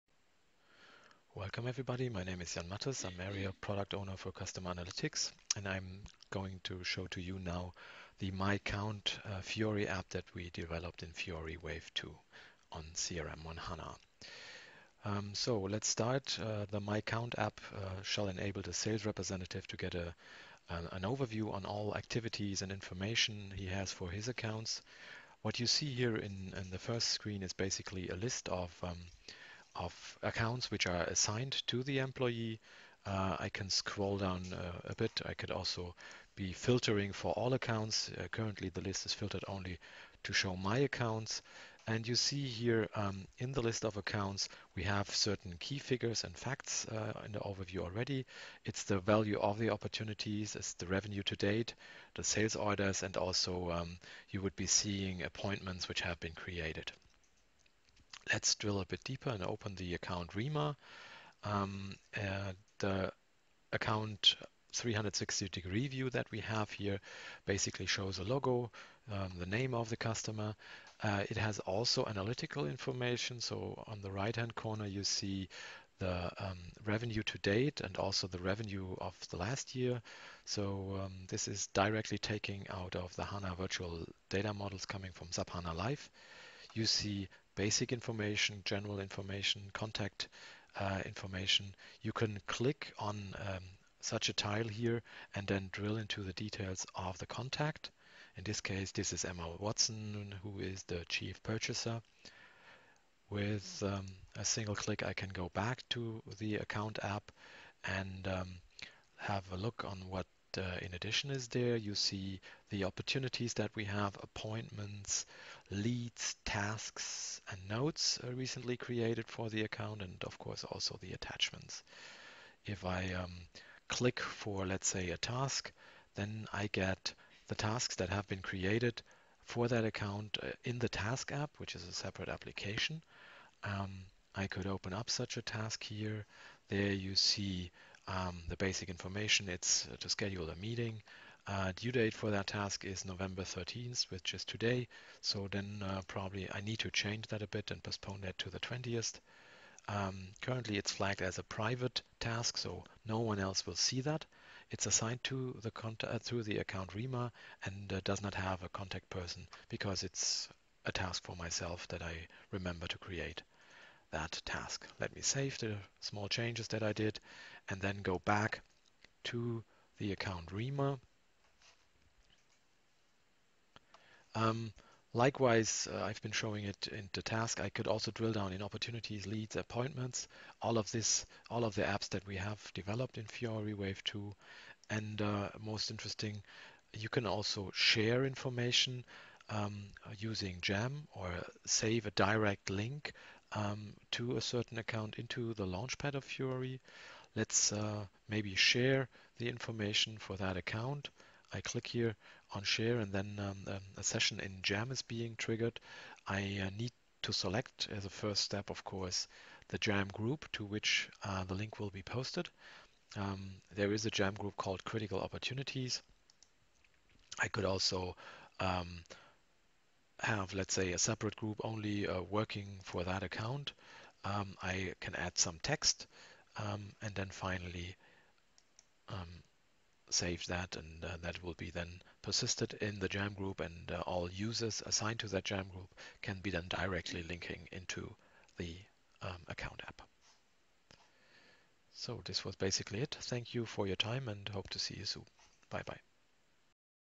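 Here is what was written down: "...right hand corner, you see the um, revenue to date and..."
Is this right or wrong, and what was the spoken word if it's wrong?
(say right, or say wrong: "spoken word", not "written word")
right.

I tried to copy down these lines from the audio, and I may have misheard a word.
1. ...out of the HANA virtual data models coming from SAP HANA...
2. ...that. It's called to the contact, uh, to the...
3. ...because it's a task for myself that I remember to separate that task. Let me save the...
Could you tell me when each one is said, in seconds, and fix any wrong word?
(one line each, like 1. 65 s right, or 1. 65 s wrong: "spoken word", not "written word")
1. 82 s right
2. 154 s wrong: "assigned", not "called"
3. 159 s wrong: "create", not "separate".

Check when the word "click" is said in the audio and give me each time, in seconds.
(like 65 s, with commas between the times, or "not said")
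92 s, 104 s, 123 s, 201 s.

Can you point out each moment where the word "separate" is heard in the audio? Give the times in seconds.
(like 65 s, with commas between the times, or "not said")
131 s, 220 s.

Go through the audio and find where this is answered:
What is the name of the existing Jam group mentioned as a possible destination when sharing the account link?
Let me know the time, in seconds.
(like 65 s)
214 s.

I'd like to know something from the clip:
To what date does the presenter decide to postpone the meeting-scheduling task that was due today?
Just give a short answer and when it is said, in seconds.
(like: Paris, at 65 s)
the 20th, at 148 s.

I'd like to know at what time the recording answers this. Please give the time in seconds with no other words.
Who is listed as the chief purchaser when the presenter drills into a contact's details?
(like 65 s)
99 s.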